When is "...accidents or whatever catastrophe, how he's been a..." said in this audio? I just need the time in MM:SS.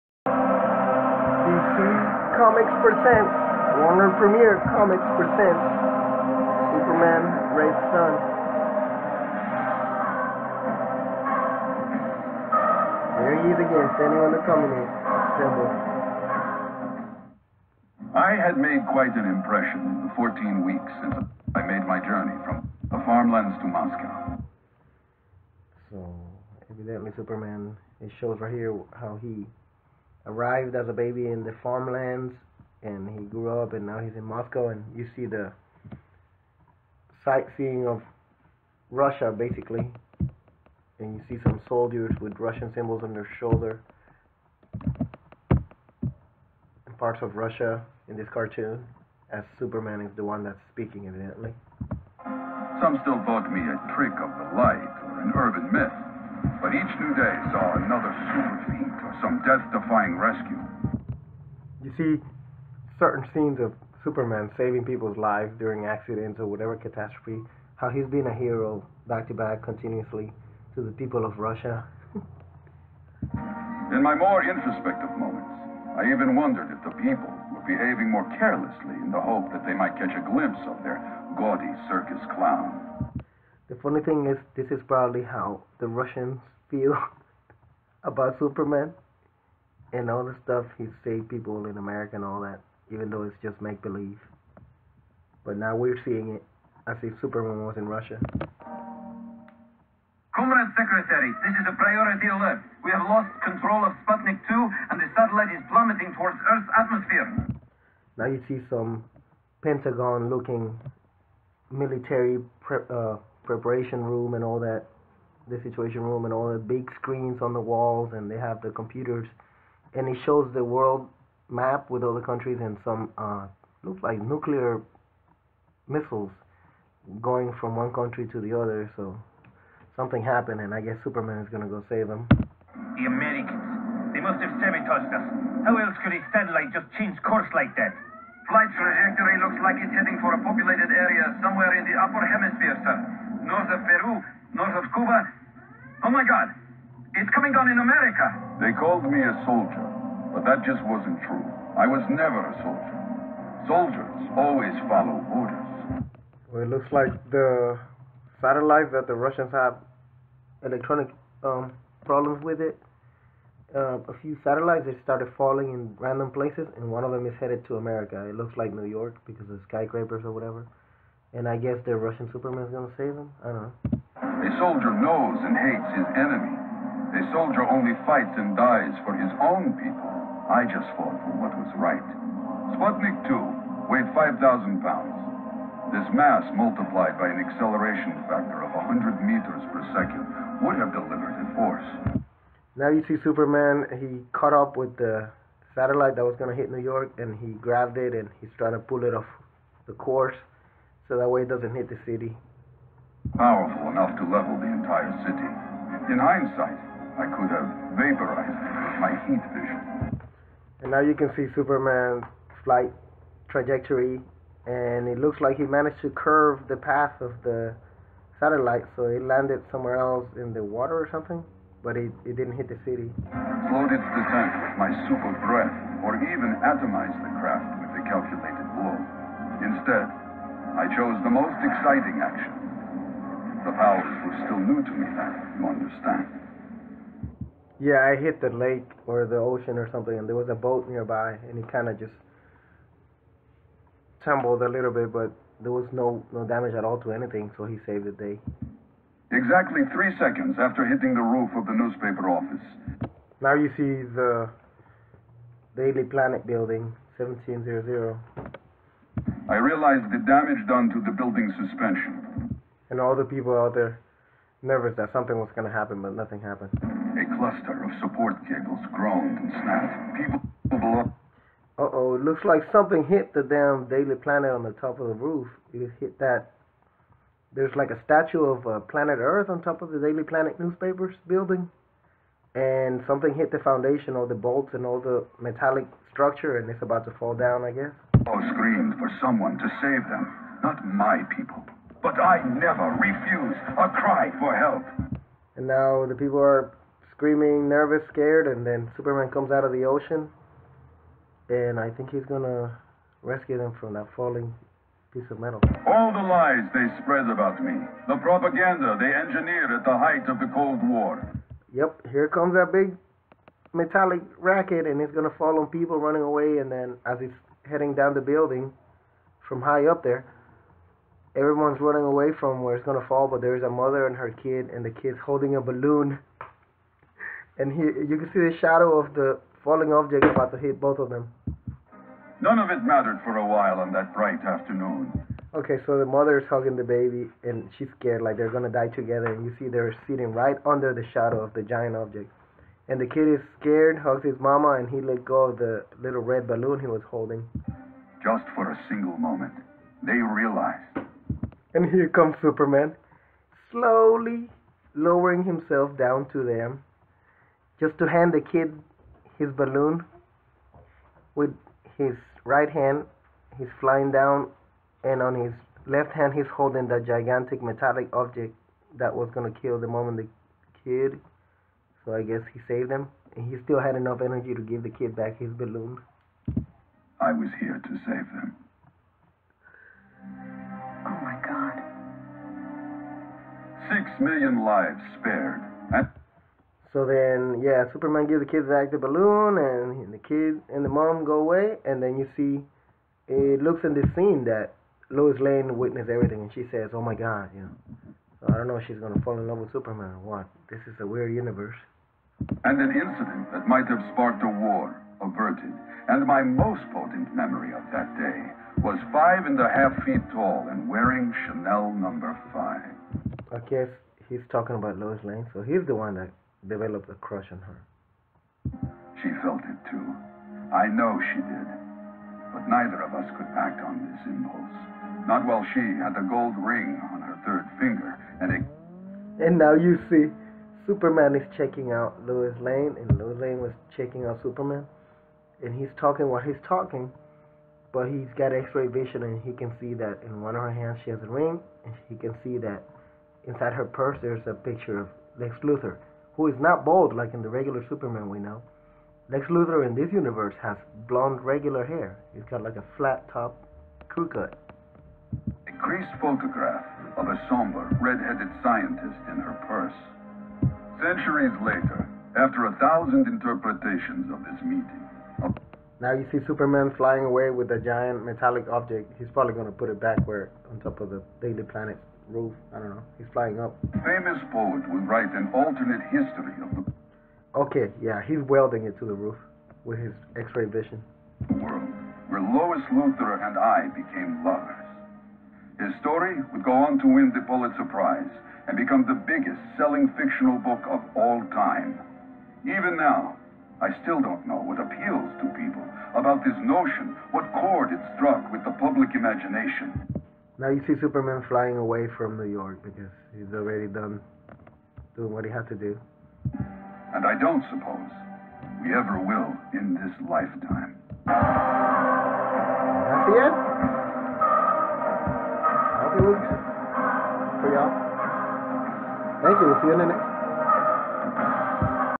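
01:05.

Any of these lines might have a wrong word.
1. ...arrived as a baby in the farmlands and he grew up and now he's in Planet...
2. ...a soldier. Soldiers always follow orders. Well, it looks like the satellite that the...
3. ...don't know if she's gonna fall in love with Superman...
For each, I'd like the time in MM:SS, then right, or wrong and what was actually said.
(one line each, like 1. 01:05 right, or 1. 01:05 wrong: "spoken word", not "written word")
1. 00:30 wrong: "Moscow", not "Planet"
2. 02:32 right
3. 06:38 right.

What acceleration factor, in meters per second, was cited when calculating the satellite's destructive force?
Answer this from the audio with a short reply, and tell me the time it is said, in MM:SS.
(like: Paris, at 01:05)
100, at 03:08.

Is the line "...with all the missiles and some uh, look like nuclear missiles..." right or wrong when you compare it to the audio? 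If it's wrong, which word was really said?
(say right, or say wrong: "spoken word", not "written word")
wrong: "countries", not "missiles".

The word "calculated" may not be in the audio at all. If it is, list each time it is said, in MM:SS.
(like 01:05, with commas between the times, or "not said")
03:48.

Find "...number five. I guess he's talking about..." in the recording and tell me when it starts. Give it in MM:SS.
06:51.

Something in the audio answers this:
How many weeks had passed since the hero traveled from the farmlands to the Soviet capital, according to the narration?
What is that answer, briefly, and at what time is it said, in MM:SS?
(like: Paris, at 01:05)
14, at 00:20.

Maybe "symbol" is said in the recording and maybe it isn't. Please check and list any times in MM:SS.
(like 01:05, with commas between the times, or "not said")
00:15, 00:42.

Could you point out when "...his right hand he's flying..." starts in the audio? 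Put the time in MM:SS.
06:01.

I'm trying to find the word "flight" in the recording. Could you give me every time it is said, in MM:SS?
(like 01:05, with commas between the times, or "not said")
02:18, 03:32.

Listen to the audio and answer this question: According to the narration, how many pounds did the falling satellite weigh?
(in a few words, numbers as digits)
5,000.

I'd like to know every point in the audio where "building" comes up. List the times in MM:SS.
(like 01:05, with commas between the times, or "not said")
04:16, 04:21, 04:41, 05:18.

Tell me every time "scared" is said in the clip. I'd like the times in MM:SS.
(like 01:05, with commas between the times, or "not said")
04:58, 05:37, 05:43.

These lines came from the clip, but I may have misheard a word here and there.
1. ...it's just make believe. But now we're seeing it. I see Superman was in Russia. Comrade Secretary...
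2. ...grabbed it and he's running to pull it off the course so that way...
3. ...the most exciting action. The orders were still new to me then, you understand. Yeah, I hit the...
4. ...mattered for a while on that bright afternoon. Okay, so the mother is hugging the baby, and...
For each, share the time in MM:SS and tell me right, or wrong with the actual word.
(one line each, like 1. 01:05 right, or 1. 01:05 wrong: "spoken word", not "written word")
1. 01:33 right
2. 03:17 wrong: "trying", not "running"
3. 03:51 wrong: "powers", not "orders"
4. 05:32 right.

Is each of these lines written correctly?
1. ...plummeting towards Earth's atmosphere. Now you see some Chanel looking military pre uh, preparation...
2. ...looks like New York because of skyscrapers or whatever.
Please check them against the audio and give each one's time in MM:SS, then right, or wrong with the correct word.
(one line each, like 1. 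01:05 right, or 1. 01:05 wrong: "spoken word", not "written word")
1. 01:45 wrong: "Pentagon", not "Chanel"
2. 02:48 right.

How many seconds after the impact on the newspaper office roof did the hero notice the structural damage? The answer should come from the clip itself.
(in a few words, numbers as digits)
3.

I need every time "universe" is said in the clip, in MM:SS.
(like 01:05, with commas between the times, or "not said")
06:41, 07:30.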